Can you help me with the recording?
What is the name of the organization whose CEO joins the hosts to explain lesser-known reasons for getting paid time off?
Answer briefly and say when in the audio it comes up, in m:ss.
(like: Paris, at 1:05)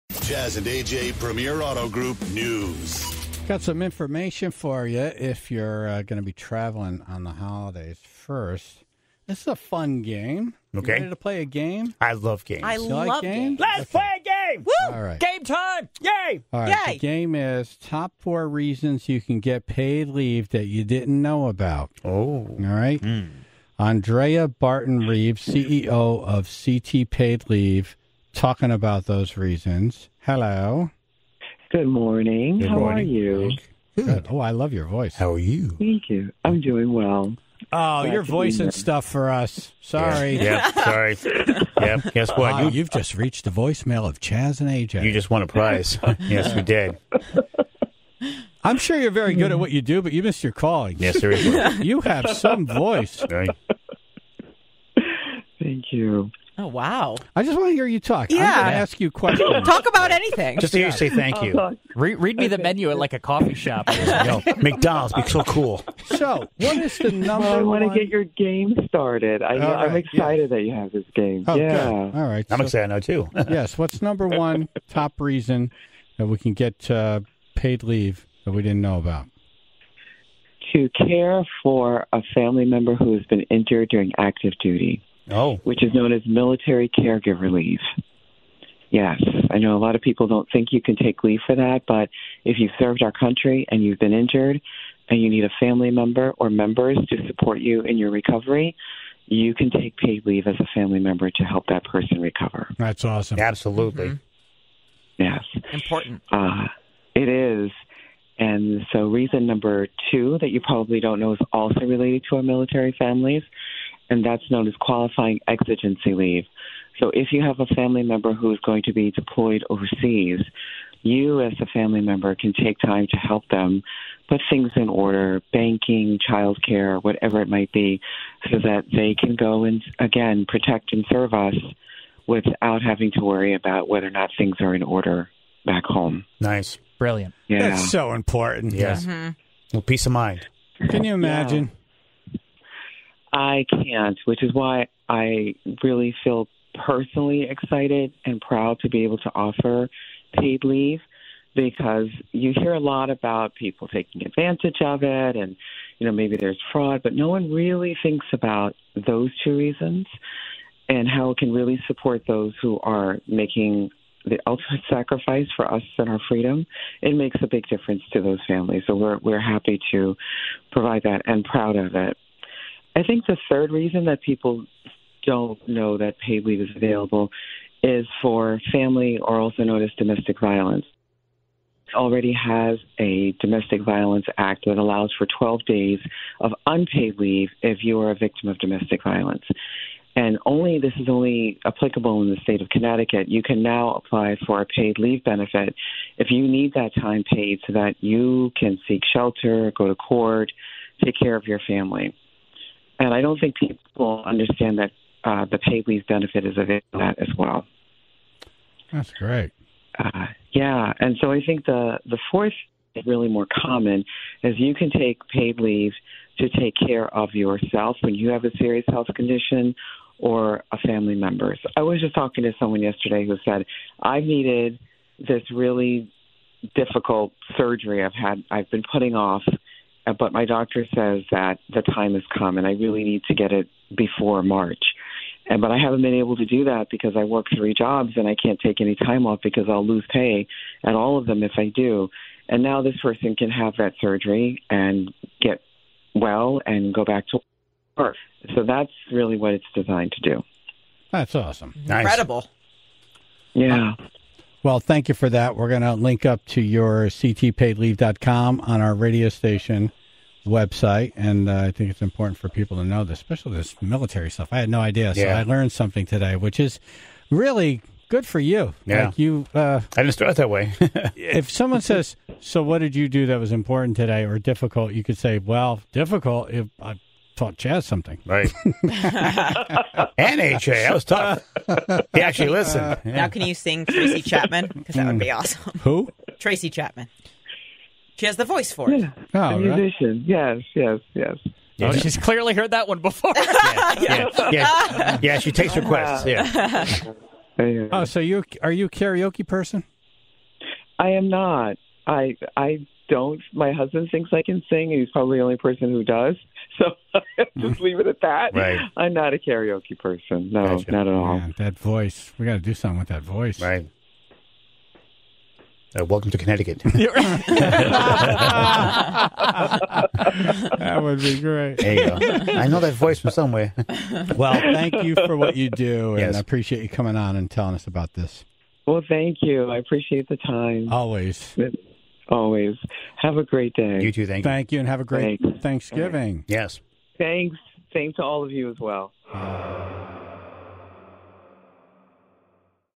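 CT Paid Leave, at 0:26.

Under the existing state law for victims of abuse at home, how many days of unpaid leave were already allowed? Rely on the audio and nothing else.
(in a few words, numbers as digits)
12 days.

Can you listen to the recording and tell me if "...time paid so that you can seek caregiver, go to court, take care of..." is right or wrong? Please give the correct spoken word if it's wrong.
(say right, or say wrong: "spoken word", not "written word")
wrong: "shelter", not "caregiver".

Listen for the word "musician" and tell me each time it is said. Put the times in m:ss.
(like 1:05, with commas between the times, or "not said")
4:49.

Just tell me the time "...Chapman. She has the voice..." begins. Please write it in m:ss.
4:46.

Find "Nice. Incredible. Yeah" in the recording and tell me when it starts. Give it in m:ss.
4:11.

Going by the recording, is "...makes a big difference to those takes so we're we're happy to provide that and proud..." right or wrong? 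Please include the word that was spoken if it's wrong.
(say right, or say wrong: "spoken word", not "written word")
wrong: "families", not "takes".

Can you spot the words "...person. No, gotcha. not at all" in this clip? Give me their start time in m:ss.
5:09.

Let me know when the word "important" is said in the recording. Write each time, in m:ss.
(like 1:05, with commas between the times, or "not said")
1:45, 2:18, 4:22, 4:33.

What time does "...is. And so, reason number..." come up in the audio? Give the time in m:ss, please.
1:47.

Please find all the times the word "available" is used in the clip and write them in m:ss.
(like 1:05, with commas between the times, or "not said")
2:56, 3:26.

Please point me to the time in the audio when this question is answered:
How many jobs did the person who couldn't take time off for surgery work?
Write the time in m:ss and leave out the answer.
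3:57.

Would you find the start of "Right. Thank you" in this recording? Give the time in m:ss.
0:53.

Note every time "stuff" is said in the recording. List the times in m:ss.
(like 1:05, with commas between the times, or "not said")
0:38, 4:24.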